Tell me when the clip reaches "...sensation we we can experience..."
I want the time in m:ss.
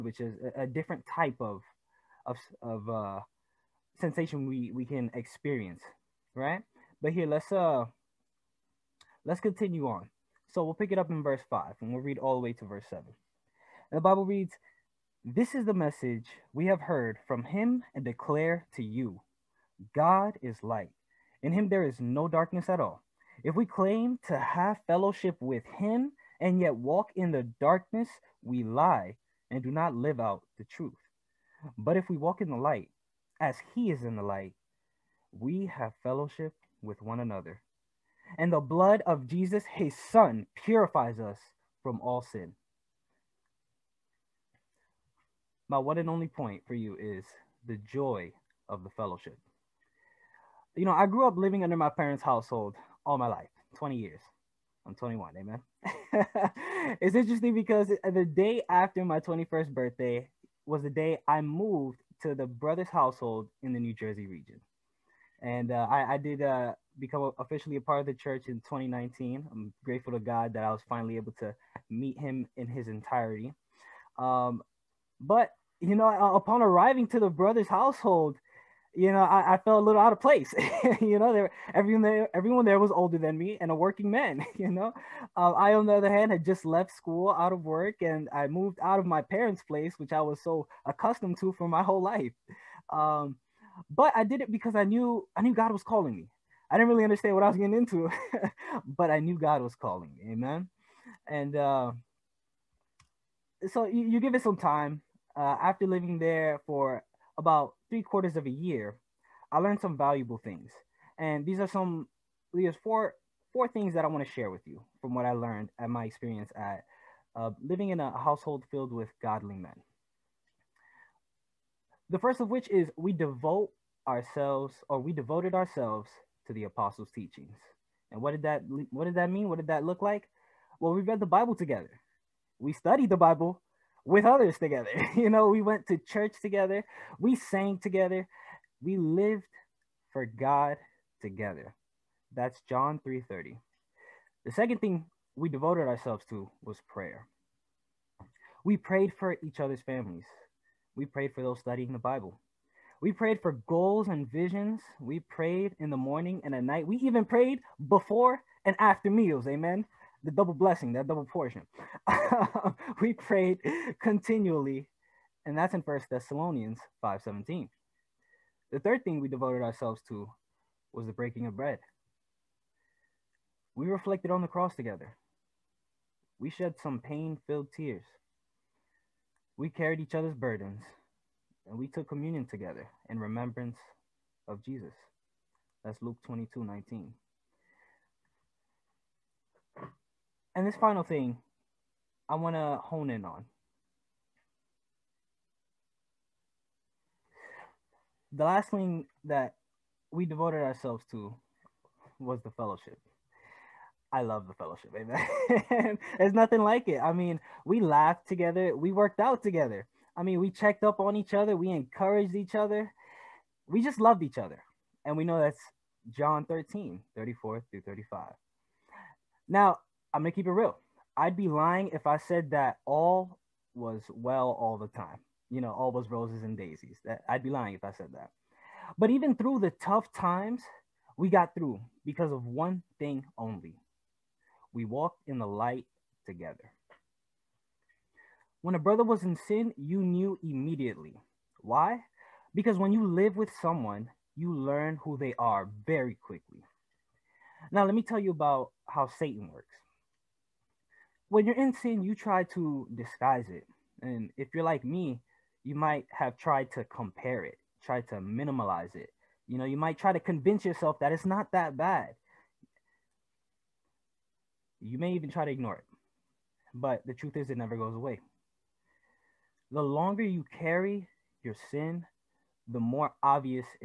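0:04.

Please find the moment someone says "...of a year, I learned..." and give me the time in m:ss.
1:48.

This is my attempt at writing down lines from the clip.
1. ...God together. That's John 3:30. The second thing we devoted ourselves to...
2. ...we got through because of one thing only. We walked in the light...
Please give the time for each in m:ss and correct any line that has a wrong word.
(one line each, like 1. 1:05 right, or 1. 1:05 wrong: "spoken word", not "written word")
1. 2:20 right
2. 3:51 right.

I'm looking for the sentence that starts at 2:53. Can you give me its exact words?
We reflected on the cross together.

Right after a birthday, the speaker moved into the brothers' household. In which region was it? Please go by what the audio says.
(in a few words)
New Jersey.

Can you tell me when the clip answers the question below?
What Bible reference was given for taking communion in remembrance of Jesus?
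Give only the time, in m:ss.
3:06.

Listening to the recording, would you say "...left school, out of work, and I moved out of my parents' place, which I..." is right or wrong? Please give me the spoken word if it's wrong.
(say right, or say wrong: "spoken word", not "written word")
right.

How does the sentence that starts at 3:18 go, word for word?
The last thing that we devoted ourselves to was the fellowship.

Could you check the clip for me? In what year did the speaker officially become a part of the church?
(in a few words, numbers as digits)
2019.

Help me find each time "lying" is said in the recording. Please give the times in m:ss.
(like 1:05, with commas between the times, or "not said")
3:41, 3:47.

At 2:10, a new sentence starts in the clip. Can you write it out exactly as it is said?
Well, we read the Bible together.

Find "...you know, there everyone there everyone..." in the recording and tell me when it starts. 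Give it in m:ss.
1:21.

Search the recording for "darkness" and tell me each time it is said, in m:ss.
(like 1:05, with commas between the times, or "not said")
0:22, 0:27.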